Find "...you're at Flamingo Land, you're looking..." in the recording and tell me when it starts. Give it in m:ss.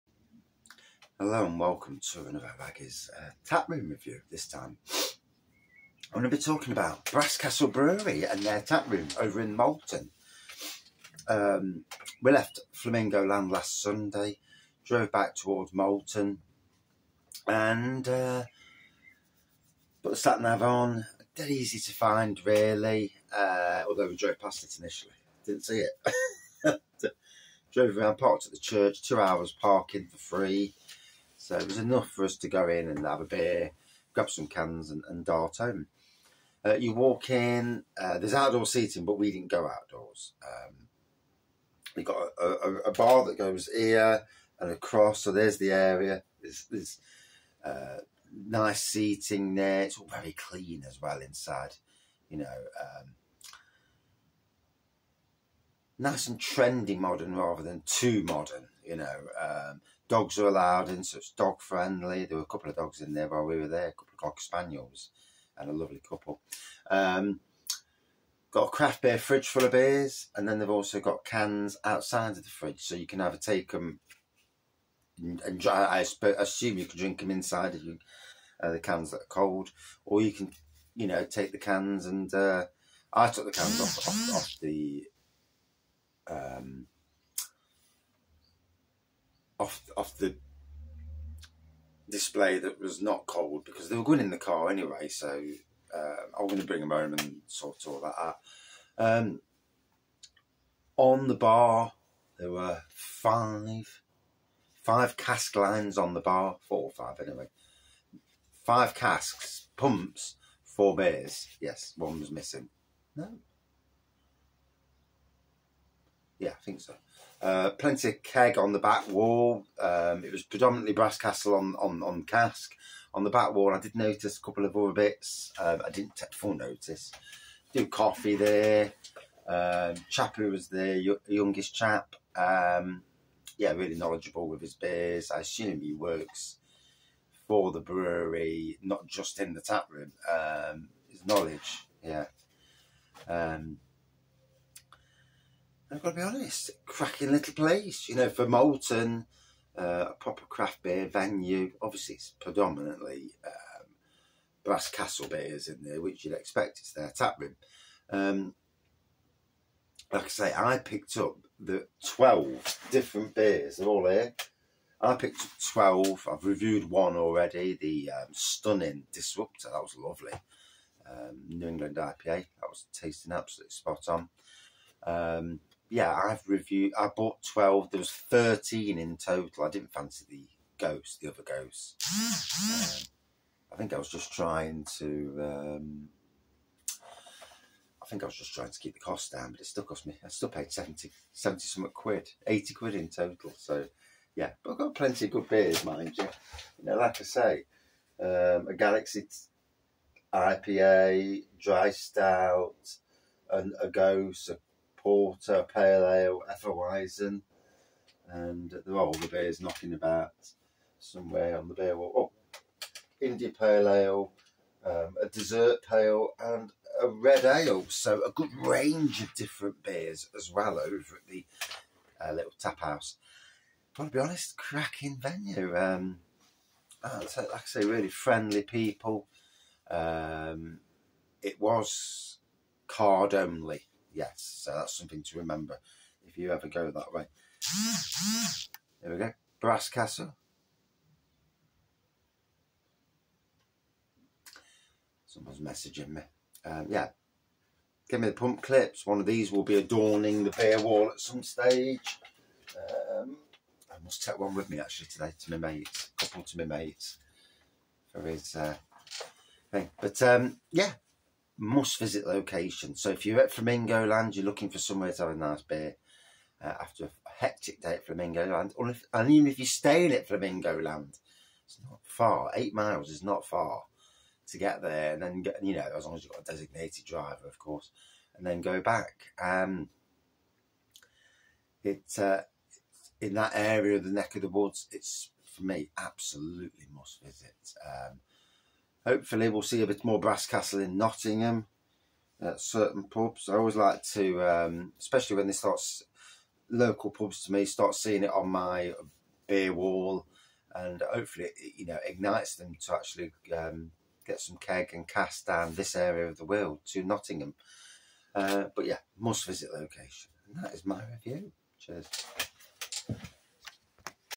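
4:23.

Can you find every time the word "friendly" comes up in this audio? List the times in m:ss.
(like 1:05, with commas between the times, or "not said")
1:01, 3:48.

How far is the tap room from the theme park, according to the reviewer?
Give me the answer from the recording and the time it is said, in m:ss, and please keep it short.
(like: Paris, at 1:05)
8 miles, at 4:32.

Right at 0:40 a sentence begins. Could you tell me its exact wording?
Um, we got a, a, a, bar that goes here and across, so there's the area.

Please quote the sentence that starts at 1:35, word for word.
So uh, I'm going to bring them home and sort all that out.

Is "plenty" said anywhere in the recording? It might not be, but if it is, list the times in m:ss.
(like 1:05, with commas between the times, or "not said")
1:57, 3:14.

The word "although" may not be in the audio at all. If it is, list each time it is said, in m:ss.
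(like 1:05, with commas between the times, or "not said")
0:23.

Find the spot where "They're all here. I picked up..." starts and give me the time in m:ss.
2:43.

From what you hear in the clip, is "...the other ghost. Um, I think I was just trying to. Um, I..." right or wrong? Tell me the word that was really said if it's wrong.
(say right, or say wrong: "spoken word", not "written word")
right.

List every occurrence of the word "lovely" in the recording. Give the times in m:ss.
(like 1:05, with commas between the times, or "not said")
1:05, 2:49.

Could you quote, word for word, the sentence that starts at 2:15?
I assume he works for the brewery, not just in the tap room.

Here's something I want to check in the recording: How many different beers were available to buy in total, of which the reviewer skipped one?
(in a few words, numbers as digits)
13.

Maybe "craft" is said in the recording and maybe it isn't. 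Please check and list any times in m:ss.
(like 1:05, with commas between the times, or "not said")
1:08, 2:30.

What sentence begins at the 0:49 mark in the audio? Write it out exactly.
It's all very clean as well inside, you know.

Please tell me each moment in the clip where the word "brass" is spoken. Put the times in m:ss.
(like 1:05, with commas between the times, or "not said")
0:07, 2:00, 2:34, 3:59, 4:50.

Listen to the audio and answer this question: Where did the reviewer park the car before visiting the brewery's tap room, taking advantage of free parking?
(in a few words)
At the church.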